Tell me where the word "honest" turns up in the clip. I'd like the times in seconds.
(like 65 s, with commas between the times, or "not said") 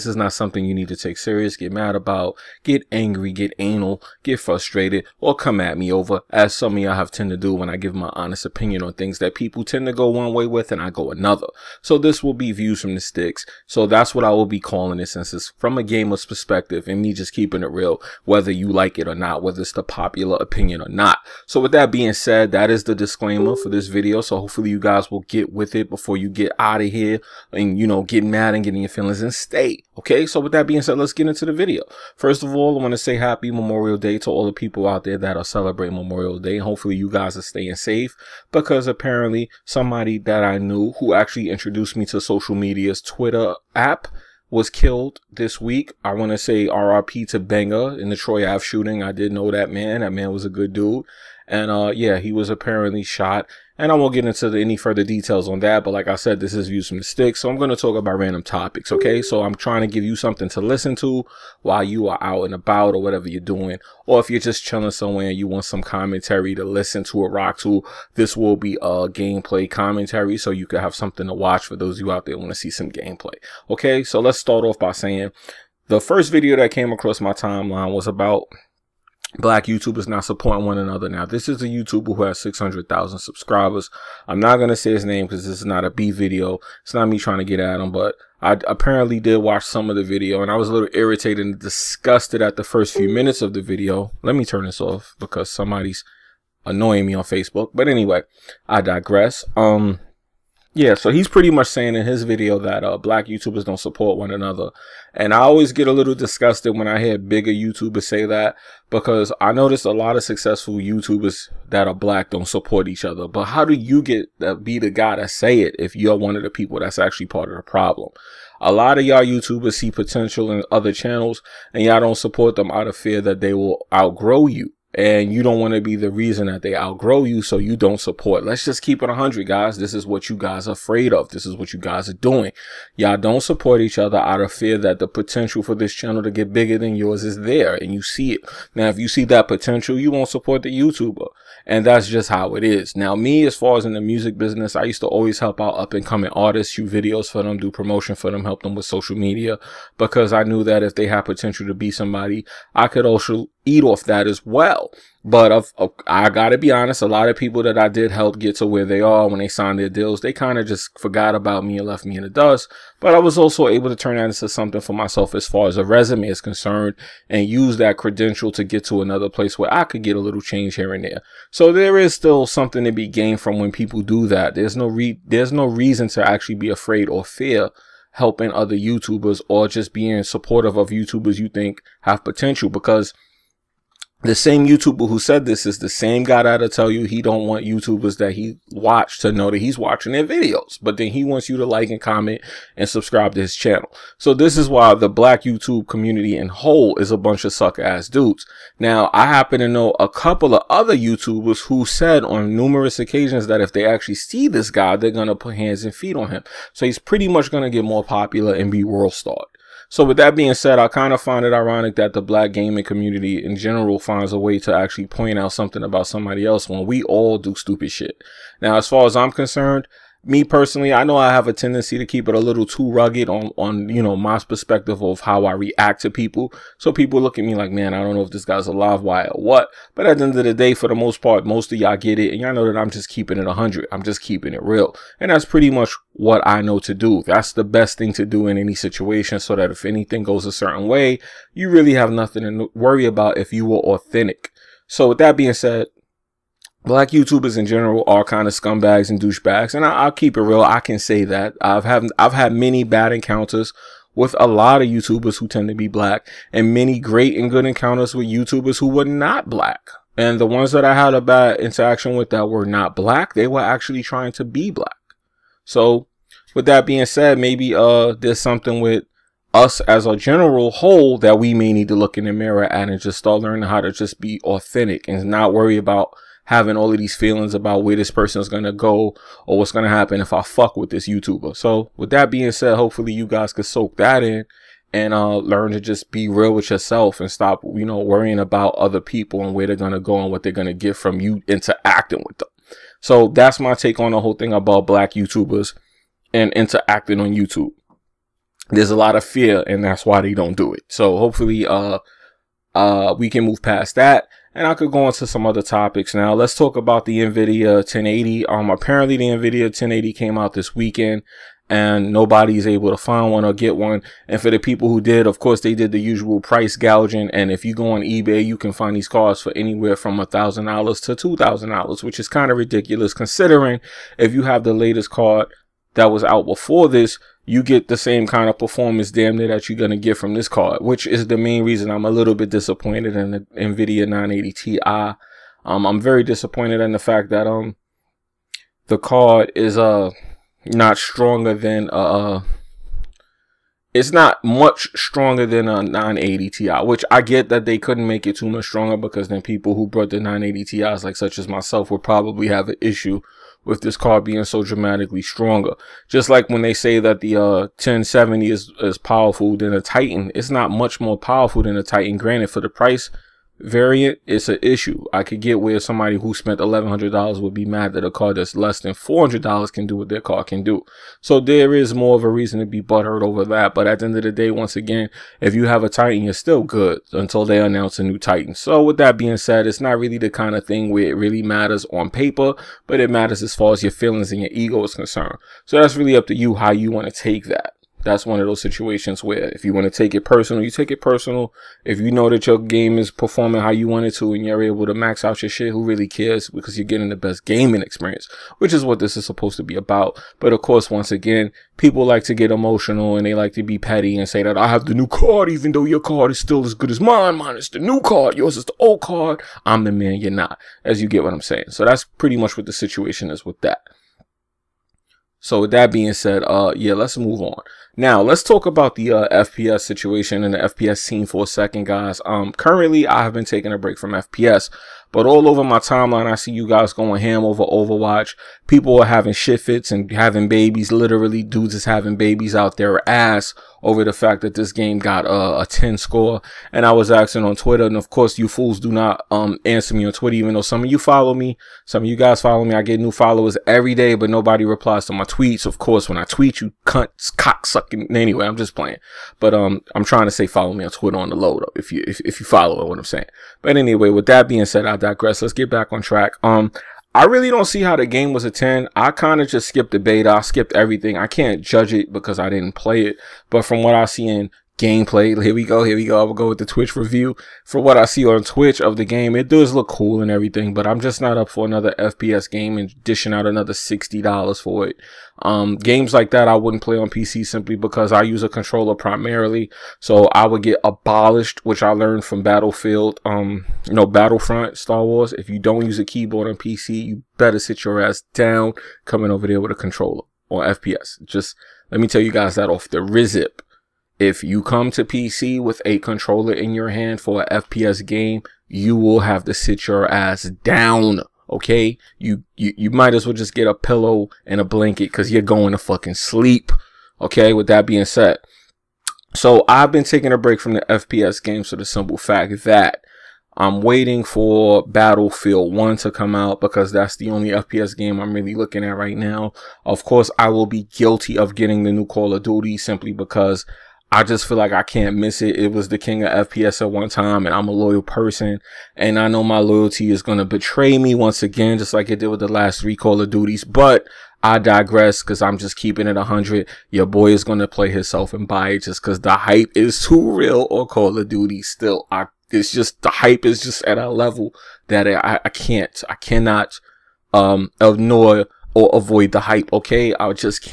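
8 s, 156 s.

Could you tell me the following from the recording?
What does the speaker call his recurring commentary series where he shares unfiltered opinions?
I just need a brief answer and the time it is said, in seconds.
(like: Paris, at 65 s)
Views from the Sticks, at 12 s.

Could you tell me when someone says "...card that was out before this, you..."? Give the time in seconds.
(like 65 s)
325 s.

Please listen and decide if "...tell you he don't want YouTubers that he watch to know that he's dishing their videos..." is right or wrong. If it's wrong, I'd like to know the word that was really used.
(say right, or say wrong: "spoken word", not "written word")
wrong: "watching", not "dishing".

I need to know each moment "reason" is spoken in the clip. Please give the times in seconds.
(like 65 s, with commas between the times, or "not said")
126 s, 175 s, 331 s, 372 s.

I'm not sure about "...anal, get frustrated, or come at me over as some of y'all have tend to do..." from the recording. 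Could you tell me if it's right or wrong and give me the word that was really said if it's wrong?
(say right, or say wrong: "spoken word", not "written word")
right.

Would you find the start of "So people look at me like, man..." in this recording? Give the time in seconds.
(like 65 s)
226 s.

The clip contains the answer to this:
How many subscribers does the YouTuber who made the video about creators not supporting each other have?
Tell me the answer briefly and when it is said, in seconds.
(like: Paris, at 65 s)
600,000, at 82 s.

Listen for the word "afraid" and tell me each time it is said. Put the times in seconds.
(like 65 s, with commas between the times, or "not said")
130 s, 176 s.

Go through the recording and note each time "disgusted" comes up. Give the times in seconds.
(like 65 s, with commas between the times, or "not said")
91 s, 106 s.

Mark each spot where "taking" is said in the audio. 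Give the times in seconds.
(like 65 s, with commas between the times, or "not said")
423 s, 510 s.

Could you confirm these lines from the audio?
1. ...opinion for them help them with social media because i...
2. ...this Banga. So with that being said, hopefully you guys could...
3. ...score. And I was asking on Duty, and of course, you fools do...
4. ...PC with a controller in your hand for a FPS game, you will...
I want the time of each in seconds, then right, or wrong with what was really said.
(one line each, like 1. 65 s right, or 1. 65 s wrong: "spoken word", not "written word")
1. 147 s wrong: "promotion", not "opinion"
2. 280 s wrong: "YouTuber", not "Banga"
3. 435 s wrong: "Twitter", not "Duty"
4. 495 s right.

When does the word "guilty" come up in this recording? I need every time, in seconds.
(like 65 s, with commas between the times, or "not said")
520 s.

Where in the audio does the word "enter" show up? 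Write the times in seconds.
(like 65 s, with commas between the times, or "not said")
not said.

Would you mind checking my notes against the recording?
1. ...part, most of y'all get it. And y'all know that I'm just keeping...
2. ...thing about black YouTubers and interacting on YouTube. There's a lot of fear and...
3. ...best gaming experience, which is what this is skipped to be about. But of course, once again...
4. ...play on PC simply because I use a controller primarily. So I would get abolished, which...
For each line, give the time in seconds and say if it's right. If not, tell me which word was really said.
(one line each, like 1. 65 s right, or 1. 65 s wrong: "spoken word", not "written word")
1. 231 s right
2. 294 s right
3. 397 s wrong: "supposed", not "skipped"
4. 476 s right.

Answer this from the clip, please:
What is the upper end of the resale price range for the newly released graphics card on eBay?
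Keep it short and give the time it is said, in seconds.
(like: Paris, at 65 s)
$2,000, at 321 s.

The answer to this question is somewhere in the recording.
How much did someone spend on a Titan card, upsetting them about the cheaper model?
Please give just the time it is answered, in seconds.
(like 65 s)
366 s.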